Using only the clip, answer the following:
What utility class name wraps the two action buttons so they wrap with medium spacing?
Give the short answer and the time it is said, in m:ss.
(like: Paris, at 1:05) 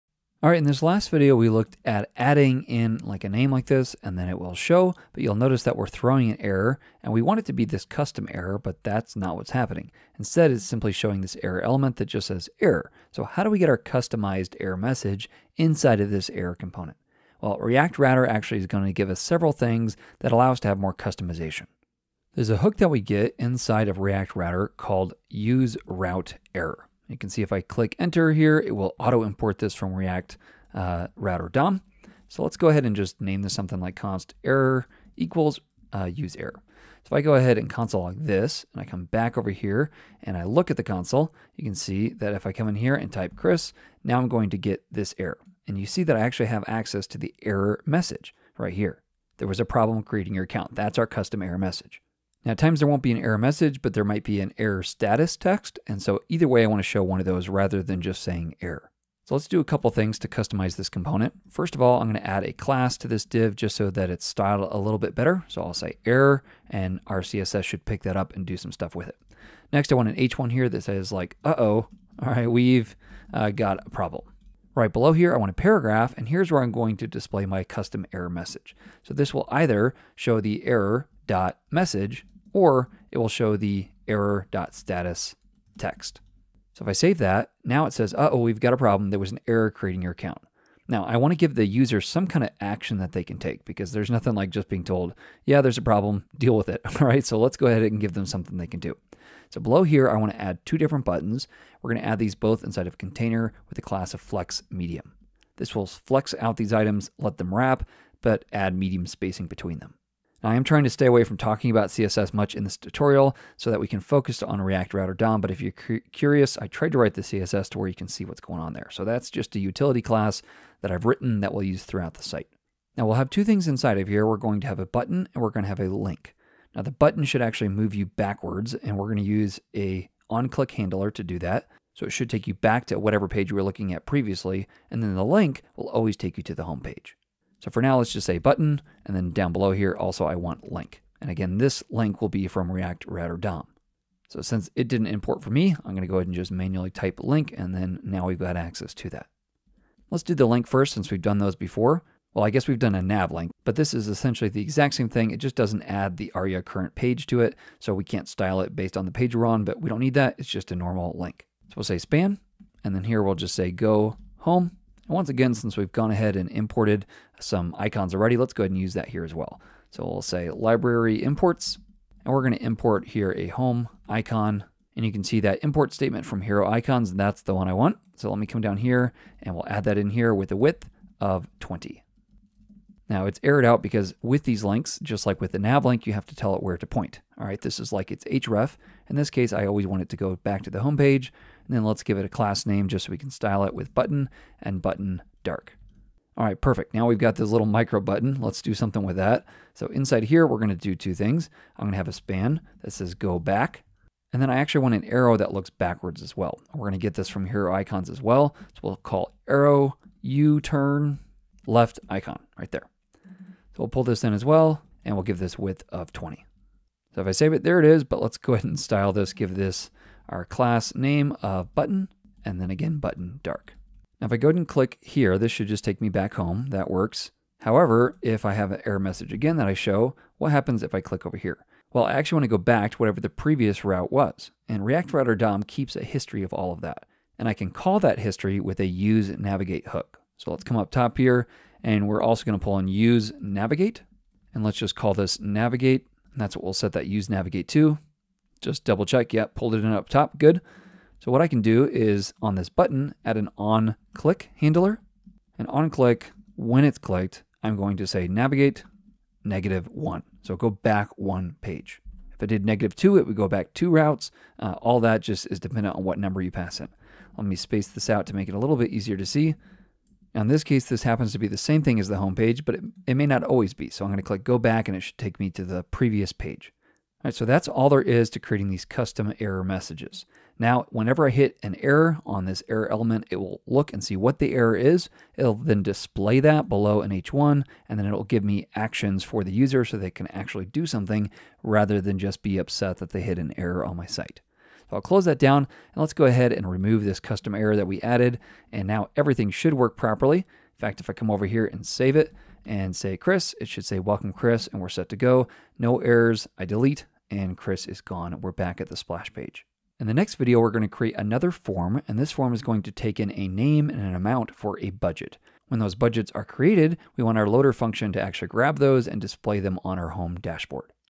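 flex medium, at 1:44.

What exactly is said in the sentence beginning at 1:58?
So that's just a utility class that I've written that we'll use throughout the site.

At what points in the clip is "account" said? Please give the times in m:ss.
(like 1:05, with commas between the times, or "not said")
0:50, 1:30.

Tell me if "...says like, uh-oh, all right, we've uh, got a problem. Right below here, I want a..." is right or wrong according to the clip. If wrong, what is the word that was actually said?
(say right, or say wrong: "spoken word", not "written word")
right.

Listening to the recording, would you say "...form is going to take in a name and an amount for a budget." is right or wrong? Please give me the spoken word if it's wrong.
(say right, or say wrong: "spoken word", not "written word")
right.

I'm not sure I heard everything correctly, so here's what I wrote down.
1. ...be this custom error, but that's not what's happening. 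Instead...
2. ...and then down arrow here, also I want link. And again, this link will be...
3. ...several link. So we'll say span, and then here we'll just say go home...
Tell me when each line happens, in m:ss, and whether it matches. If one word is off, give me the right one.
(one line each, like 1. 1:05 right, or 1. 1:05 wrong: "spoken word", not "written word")
1. 0:07 right
2. 2:19 wrong: "below", not "arrow"
3. 2:40 wrong: "normal", not "several".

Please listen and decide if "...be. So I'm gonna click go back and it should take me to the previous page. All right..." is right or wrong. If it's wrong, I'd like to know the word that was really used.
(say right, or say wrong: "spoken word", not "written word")
right.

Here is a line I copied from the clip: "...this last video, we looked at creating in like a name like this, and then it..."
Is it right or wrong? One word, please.
wrong.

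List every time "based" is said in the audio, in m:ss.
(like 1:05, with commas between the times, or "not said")
2:38.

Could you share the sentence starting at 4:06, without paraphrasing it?
And that's what we'll set that use navigate to.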